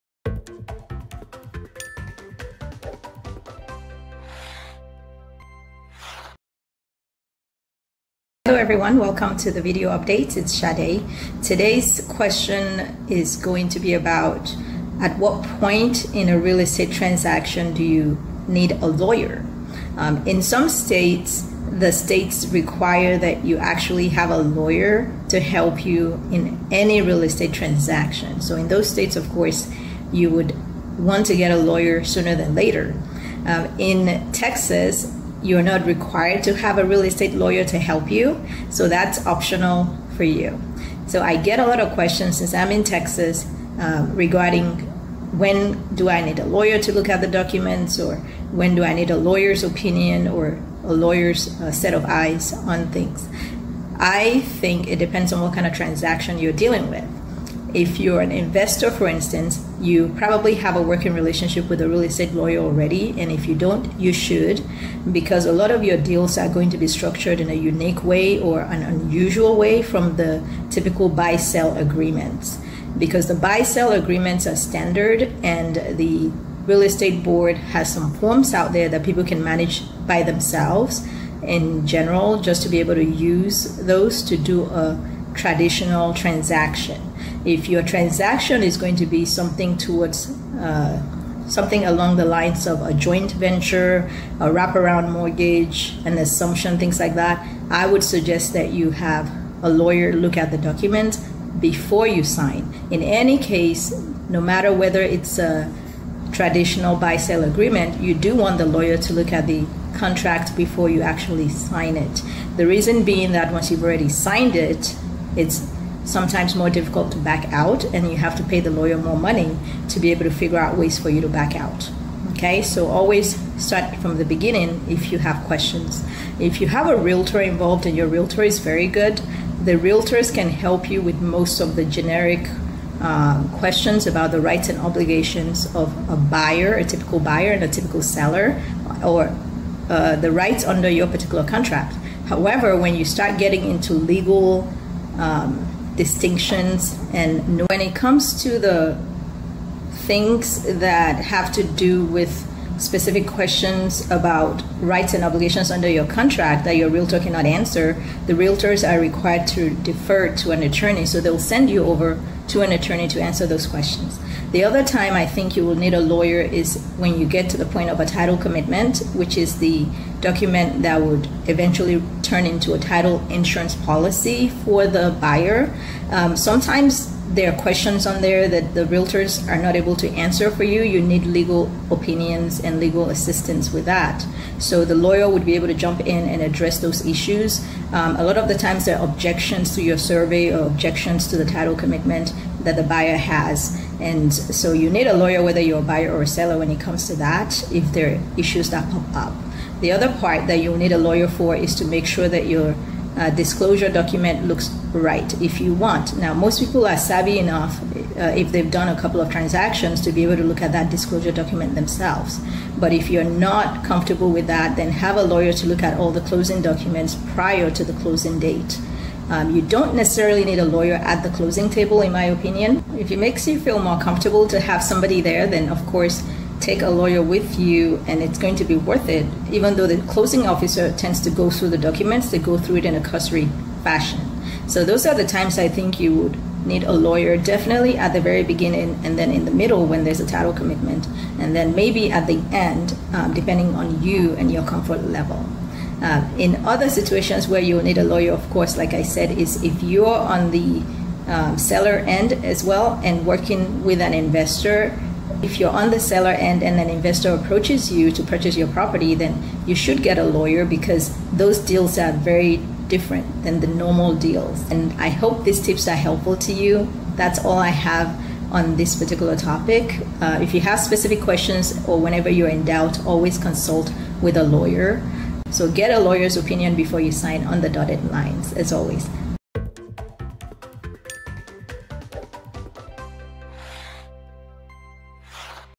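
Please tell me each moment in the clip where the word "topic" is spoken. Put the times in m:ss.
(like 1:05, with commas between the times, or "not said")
4:29.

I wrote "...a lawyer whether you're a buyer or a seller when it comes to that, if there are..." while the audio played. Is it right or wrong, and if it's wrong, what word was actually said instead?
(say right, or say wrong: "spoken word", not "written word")
right.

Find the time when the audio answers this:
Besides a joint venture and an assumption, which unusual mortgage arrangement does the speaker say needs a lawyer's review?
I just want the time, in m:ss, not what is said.
1:34.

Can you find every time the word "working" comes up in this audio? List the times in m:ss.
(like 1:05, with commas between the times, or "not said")
1:00, 4:13.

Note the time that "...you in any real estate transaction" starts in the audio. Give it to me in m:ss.
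0:25.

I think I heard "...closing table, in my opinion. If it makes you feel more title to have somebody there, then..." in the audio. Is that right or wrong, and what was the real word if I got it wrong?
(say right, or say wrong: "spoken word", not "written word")
wrong: "comfortable", not "title".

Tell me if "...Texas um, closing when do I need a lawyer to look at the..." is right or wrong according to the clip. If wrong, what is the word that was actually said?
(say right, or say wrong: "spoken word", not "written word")
wrong: "regarding", not "closing".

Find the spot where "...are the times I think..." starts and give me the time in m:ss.
3:55.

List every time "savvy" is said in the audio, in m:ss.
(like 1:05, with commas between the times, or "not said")
3:26.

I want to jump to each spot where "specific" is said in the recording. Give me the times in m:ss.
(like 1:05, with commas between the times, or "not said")
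2:32, 4:30.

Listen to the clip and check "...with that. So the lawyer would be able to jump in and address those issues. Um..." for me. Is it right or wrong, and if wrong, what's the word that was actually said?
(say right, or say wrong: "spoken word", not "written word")
right.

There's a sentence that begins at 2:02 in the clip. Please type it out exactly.
Okay, so always start from the beginning if you have questions.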